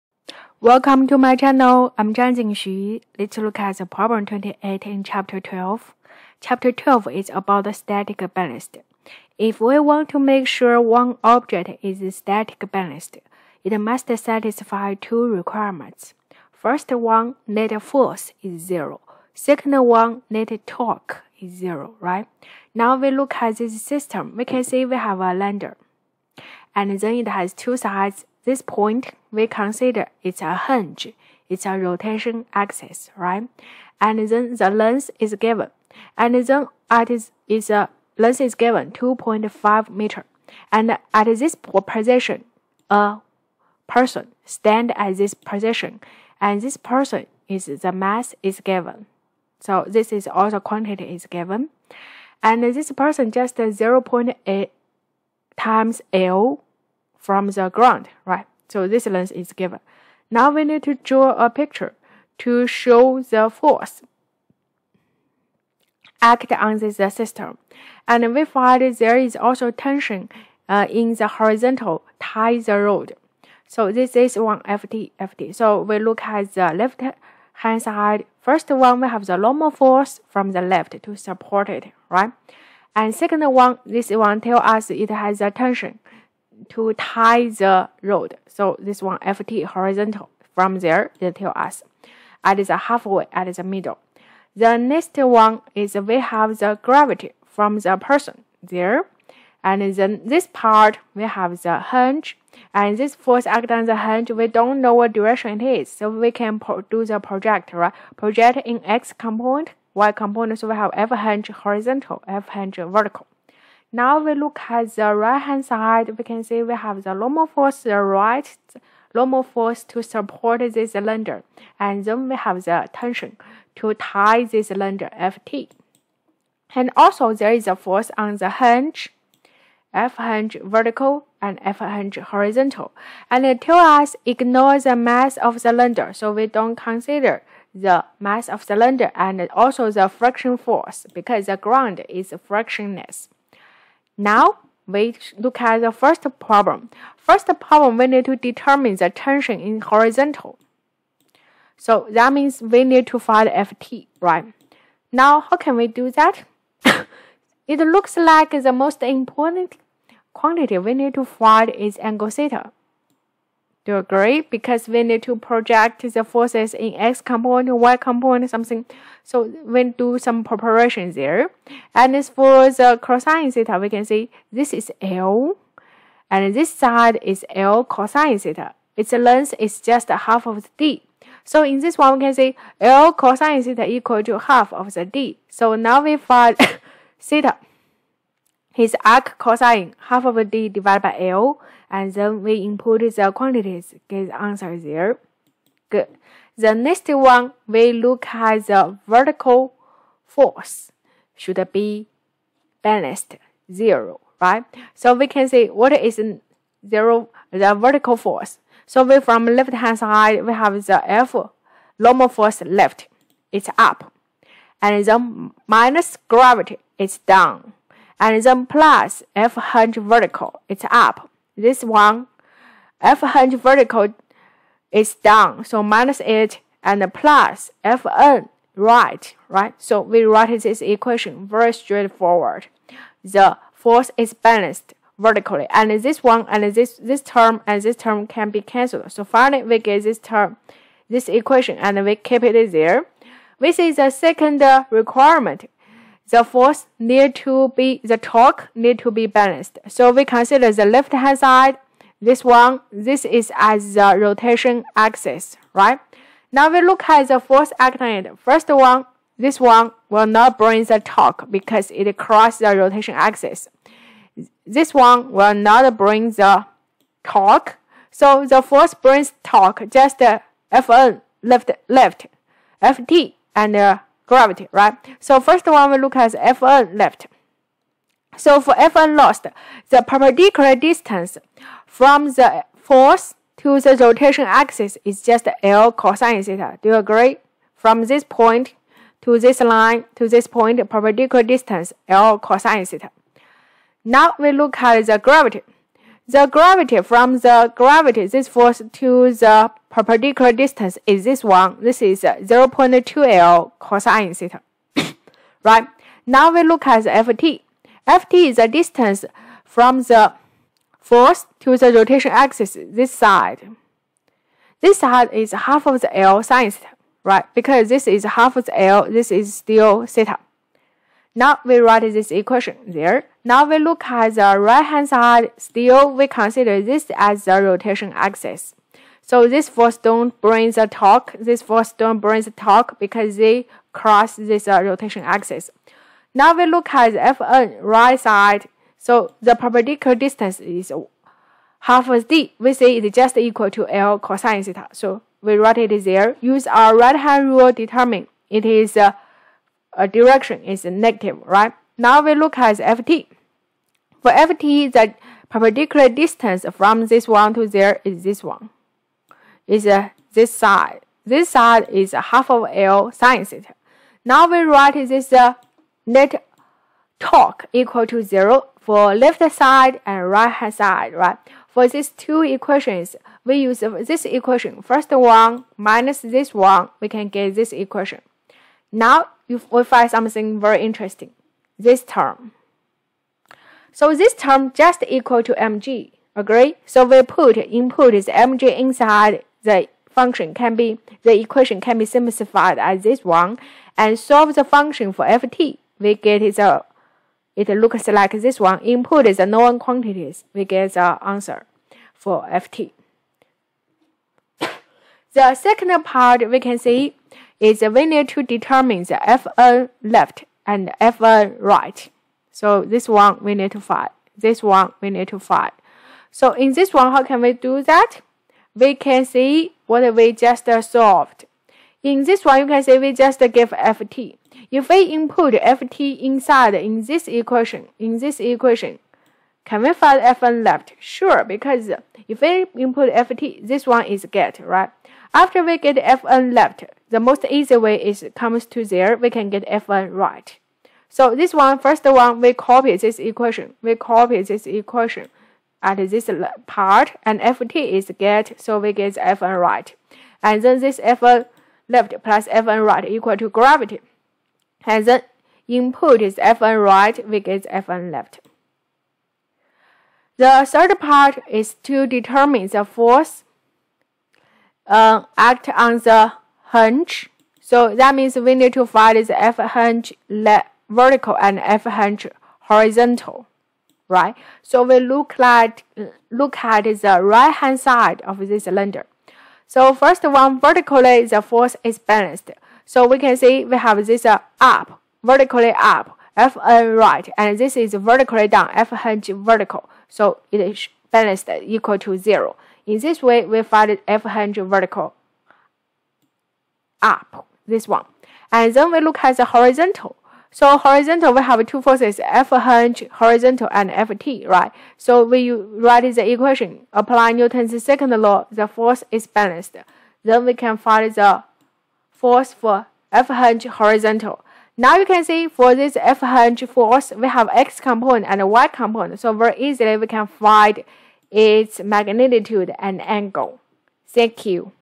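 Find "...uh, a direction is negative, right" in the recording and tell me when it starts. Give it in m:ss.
5:48.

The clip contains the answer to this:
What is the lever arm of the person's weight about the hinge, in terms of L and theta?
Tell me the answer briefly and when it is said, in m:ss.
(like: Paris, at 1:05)
0.2L cosine theta, at 5:02.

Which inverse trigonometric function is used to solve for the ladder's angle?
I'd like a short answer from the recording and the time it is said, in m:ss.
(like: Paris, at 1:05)
Arc cosine, at 3:09.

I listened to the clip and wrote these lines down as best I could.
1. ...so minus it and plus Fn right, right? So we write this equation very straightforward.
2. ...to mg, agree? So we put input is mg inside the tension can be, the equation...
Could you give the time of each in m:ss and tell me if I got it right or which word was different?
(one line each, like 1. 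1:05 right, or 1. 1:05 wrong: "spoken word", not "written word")
1. 3:45 right
2. 6:25 wrong: "function", not "tension".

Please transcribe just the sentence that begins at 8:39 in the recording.
So very easily we can find its magnitude and angle.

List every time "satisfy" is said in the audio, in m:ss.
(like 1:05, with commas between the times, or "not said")
0:14.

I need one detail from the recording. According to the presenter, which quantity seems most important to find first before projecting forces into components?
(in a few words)
Angle theta.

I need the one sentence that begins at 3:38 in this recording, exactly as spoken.
And then plus F hinge vertical, it's up.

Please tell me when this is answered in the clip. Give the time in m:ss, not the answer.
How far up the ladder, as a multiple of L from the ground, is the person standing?
0:53.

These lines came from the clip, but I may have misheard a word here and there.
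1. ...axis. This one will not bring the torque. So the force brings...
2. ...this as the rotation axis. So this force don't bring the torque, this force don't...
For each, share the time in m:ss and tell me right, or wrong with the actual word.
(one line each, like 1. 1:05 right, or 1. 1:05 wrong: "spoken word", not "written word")
1. 4:23 right
2. 5:26 right.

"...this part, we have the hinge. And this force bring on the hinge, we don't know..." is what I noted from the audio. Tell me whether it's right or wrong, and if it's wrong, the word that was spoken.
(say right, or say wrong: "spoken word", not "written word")
wrong: "acting", not "bring".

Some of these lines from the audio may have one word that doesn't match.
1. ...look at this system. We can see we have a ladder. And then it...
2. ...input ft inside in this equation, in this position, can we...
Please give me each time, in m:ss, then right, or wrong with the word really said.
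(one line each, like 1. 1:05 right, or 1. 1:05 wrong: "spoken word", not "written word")
1. 0:23 right
2. 7:05 wrong: "equation", not "position".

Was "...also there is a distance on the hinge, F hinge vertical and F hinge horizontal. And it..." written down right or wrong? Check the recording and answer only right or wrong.
wrong.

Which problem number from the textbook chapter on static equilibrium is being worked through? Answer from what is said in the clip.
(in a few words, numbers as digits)
28.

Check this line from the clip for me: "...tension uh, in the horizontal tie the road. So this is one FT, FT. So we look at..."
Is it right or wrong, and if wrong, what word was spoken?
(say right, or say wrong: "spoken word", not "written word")
right.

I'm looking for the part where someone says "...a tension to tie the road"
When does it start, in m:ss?
1:25.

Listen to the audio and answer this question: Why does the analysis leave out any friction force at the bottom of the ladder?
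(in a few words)
The ground is frictionless.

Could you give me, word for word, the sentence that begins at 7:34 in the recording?
And then input is fn right, we get fn left.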